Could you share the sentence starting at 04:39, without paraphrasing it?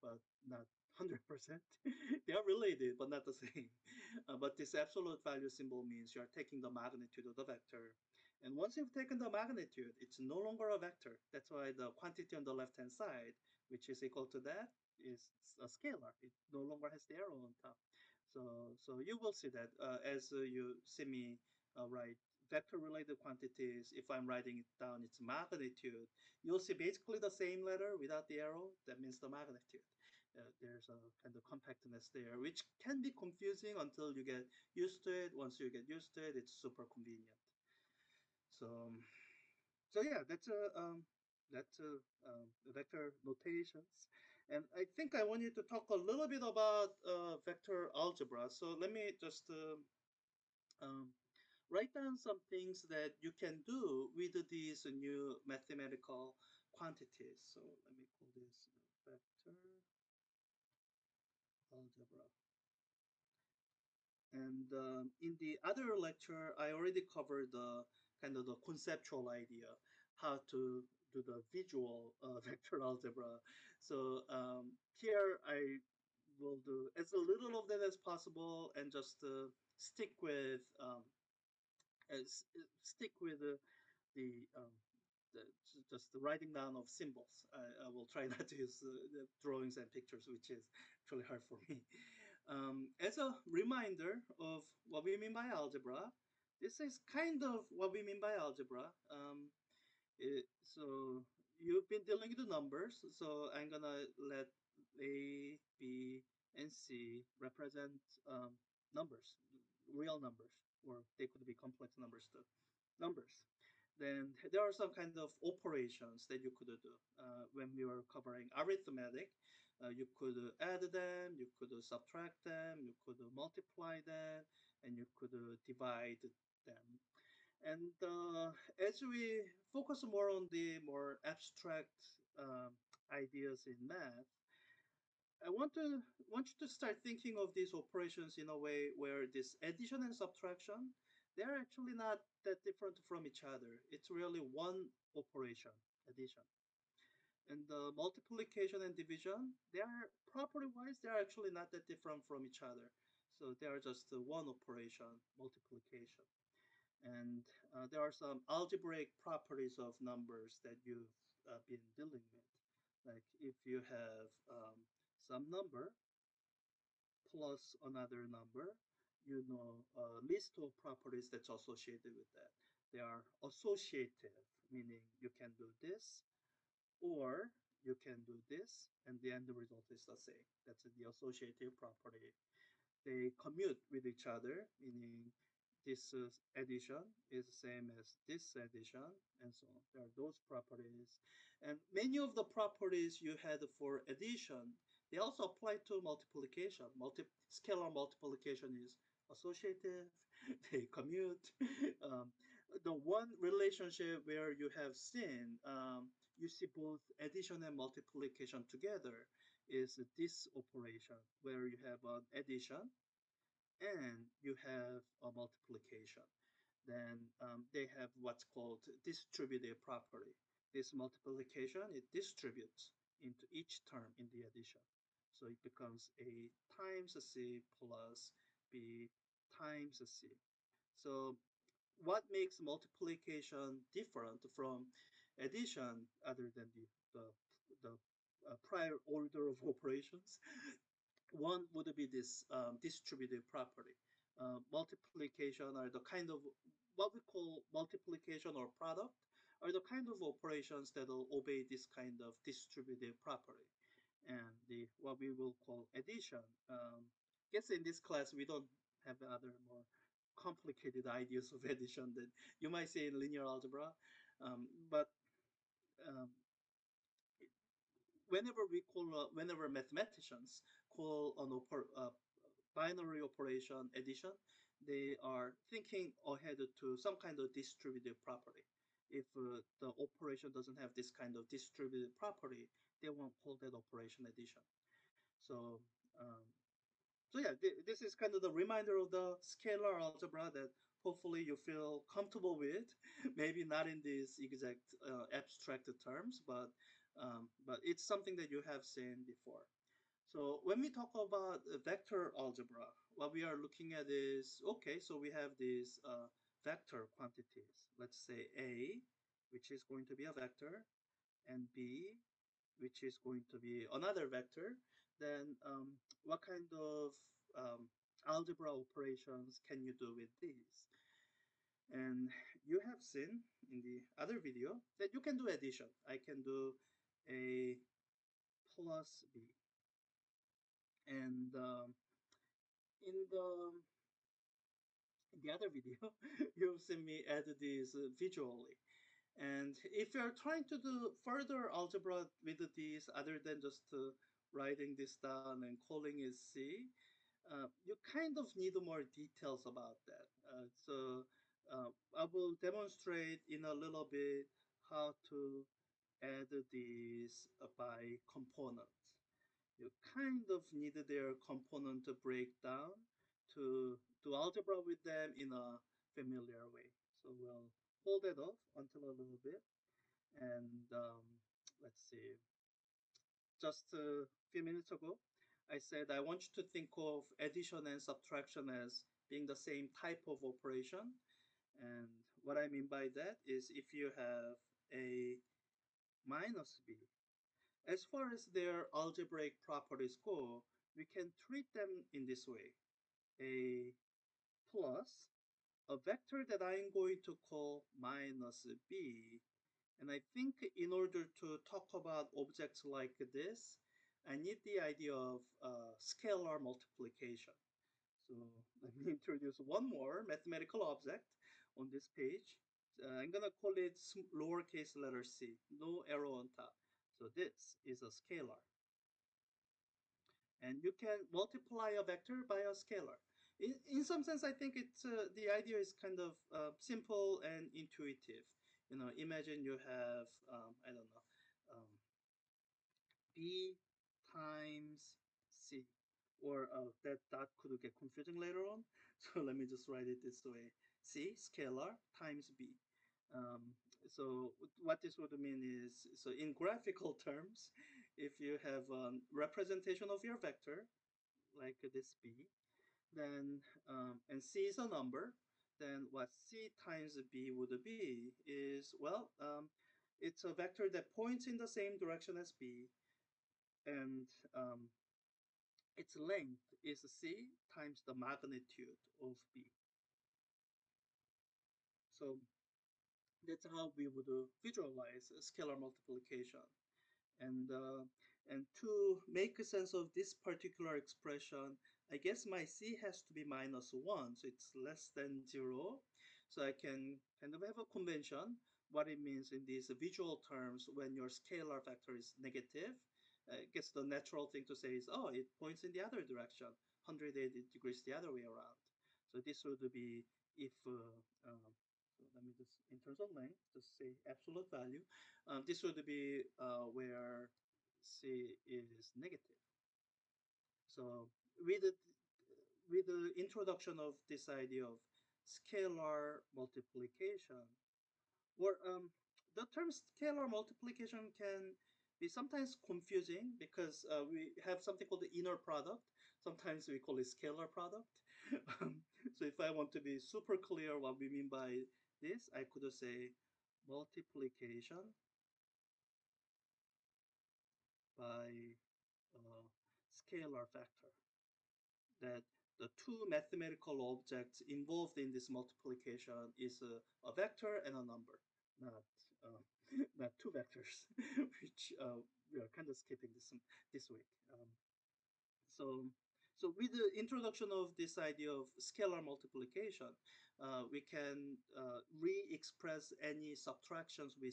If uh, the operation doesn't have this kind of distributive property, they won't call that operation addition.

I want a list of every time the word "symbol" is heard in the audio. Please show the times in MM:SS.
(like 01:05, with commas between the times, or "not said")
00:05, 01:26.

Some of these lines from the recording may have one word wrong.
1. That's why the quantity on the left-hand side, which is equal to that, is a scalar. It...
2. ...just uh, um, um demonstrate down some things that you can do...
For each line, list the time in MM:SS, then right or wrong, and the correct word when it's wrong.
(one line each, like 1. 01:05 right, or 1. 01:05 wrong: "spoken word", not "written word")
1. 00:11 right
2. 00:49 wrong: "write", not "demonstrate".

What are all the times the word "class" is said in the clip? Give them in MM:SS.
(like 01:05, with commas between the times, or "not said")
04:17.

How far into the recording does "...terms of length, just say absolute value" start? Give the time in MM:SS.
08:22.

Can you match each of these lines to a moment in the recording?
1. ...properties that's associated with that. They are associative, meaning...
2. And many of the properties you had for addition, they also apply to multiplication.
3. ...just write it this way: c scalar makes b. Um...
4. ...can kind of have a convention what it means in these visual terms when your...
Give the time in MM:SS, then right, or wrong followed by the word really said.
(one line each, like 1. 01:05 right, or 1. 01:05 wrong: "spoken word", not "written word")
1. 02:50 right
2. 03:11 right
3. 07:19 wrong: "times", not "makes"
4. 08:06 right.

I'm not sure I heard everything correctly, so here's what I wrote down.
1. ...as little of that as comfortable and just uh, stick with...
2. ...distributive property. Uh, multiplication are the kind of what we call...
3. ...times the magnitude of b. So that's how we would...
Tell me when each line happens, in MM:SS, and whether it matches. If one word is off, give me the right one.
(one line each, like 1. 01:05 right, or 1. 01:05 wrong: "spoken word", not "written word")
1. 01:16 wrong: "possible", not "comfortable"
2. 04:02 right
3. 07:47 right.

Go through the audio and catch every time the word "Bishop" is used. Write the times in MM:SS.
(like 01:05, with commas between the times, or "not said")
not said.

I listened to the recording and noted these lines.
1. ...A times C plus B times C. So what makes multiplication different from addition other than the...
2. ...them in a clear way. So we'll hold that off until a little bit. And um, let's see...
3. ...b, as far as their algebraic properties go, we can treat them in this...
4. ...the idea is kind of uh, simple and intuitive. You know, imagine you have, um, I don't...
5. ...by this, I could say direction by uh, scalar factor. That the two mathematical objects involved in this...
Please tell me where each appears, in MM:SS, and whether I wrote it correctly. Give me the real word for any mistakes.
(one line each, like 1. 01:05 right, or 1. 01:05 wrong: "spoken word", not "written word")
1. 03:46 right
2. 06:05 wrong: "familiar", not "clear"
3. 06:26 right
4. 07:05 right
5. 08:51 wrong: "multiplication", not "direction".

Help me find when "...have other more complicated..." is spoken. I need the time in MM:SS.
04:18.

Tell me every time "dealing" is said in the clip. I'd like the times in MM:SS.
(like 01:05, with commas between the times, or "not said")
01:42, 02:41.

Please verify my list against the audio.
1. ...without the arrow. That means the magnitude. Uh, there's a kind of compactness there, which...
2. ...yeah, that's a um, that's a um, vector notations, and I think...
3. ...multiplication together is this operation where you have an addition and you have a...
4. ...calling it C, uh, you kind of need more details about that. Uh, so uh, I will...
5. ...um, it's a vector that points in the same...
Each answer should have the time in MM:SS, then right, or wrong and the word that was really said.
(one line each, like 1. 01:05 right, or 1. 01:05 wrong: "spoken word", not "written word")
1. 00:27 right
2. 00:40 right
3. 03:27 right
4. 05:45 right
5. 07:39 right.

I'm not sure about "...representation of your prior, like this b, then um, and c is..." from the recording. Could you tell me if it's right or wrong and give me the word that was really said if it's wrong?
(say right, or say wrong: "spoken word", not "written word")
wrong: "vector", not "prior".